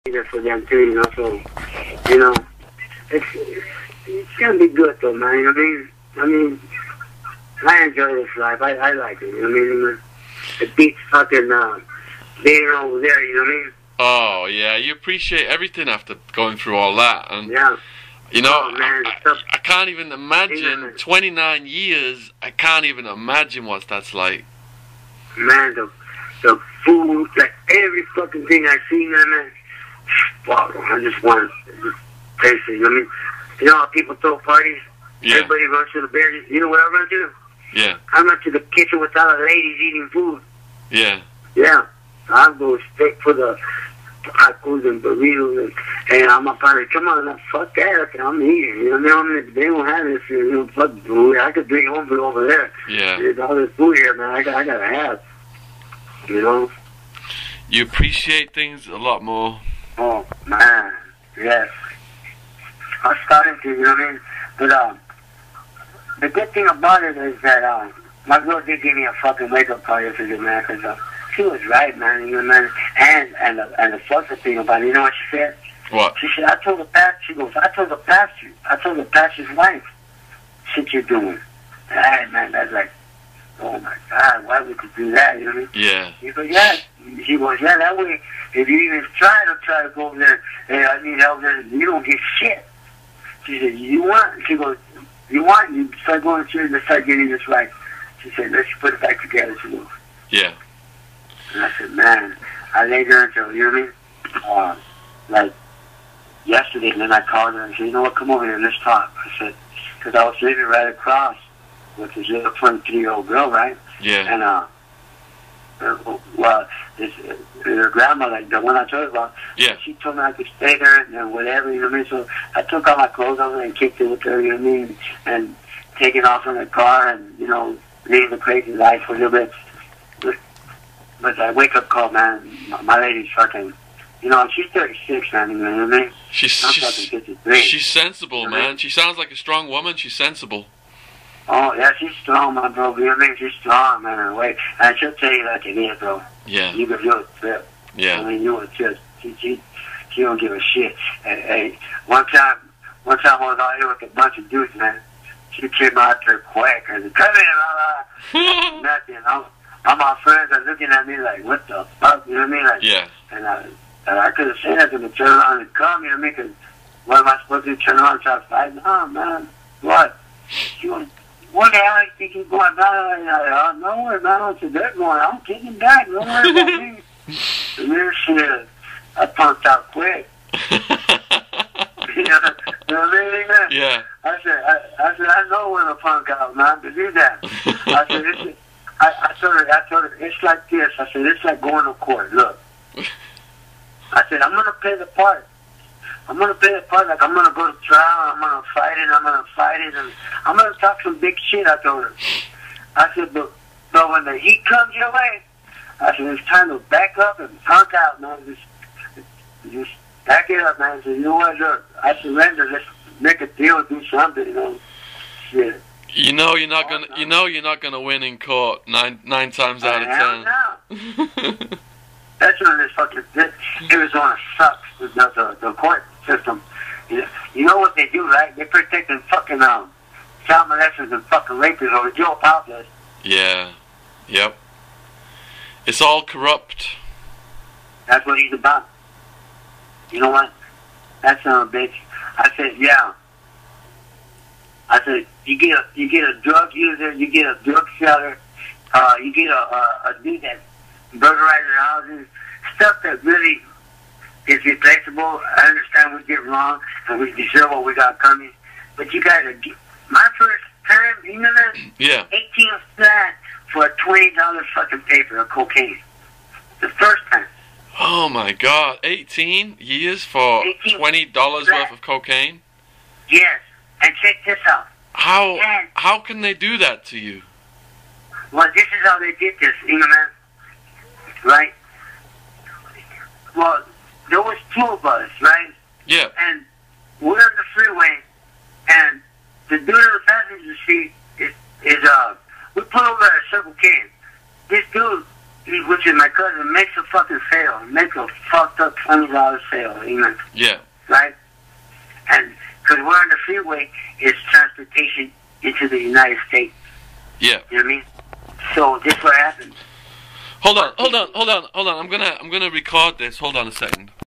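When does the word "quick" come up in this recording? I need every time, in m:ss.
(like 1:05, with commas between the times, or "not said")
2:36, 2:59.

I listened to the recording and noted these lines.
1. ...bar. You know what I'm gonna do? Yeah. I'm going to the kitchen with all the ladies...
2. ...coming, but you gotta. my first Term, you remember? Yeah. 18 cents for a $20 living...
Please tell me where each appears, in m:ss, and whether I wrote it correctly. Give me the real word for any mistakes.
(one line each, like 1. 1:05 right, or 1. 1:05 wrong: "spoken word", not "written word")
1. 0:36 right
2. 4:18 wrong: "fucking", not "living".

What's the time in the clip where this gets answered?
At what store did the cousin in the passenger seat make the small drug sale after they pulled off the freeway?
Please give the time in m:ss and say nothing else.
4:53.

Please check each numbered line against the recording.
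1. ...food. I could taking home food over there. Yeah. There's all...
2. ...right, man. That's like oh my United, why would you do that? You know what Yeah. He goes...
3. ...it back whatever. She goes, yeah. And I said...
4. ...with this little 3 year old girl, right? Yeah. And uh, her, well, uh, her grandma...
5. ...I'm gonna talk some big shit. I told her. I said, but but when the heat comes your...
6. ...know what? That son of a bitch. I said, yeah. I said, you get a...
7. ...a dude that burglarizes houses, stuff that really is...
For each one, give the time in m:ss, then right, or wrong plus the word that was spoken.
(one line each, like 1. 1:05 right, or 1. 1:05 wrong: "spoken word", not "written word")
1. 0:51 wrong: "bring", not "taking"
2. 1:21 wrong: "God", not "United"
3. 1:38 wrong: "together", not "whatever"
4. 1:51 right
5. 3:20 right
6. 4:00 right
7. 4:10 right.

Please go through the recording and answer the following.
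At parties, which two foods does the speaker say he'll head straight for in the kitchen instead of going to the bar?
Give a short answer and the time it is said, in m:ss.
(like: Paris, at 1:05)
tacos and burritos, at 0:44.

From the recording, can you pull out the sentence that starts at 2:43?
And I and I couldn't say nothing, the turn around and come.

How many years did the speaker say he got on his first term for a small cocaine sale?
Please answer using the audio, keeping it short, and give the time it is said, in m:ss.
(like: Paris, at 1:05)
18, at 4:29.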